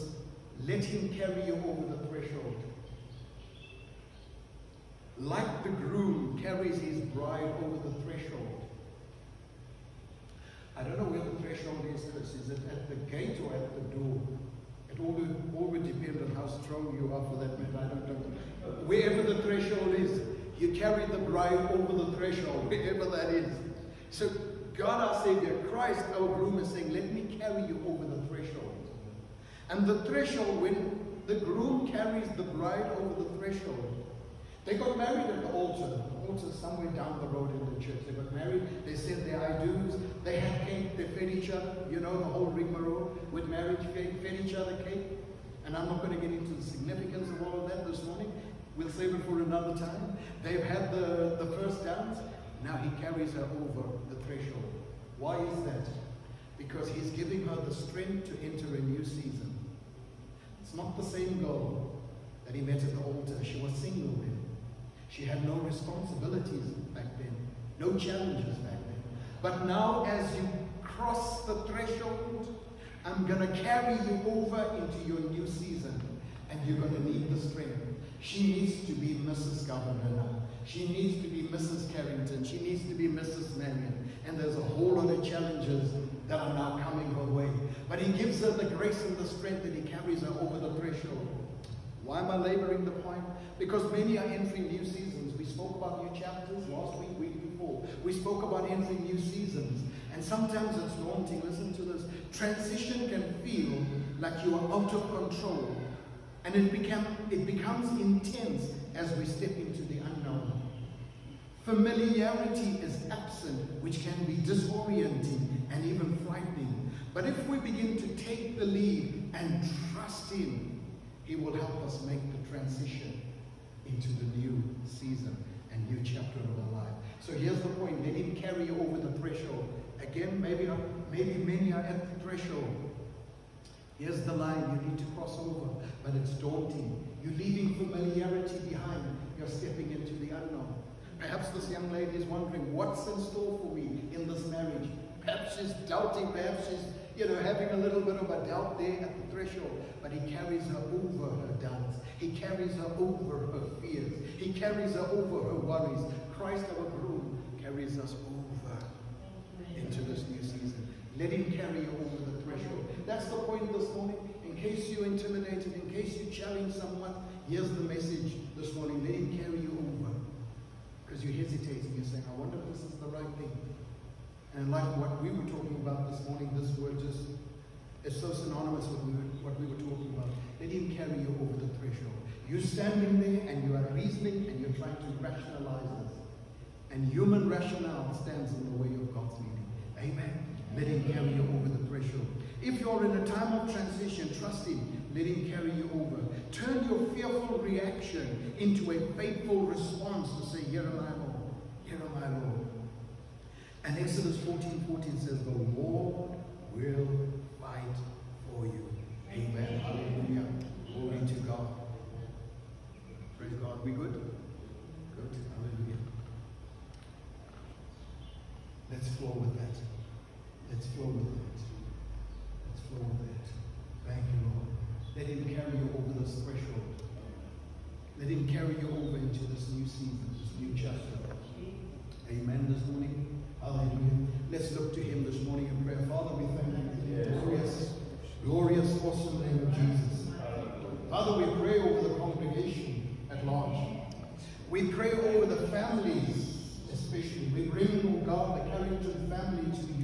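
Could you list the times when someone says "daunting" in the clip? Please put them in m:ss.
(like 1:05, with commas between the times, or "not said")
1:40, 2:16.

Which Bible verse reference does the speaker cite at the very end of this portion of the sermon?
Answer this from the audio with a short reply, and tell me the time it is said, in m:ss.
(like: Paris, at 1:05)
Exodus 14:14, at 3:23.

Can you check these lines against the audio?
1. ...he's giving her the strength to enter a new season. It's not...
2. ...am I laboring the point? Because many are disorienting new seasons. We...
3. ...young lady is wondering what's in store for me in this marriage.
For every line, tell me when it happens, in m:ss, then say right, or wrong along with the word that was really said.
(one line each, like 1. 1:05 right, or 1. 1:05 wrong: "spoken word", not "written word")
1. 0:56 right
2. 1:32 wrong: "entering", not "disorienting"
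3. 2:21 right.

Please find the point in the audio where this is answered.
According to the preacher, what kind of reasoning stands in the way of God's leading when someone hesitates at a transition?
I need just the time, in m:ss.
3:07.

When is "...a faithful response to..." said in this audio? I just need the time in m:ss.
3:18.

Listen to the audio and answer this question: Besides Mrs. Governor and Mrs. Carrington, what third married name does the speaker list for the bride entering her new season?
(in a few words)
Mrs. Marion.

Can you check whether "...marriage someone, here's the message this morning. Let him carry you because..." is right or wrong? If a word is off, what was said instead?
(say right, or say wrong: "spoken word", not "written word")
wrong: "challenge", not "marriage".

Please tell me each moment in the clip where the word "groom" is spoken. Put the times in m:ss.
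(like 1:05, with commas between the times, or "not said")
0:05, 0:26, 0:31, 2:36.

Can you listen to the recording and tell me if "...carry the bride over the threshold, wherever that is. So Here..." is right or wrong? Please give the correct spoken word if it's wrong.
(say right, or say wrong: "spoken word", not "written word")
wrong: "God", not "Here".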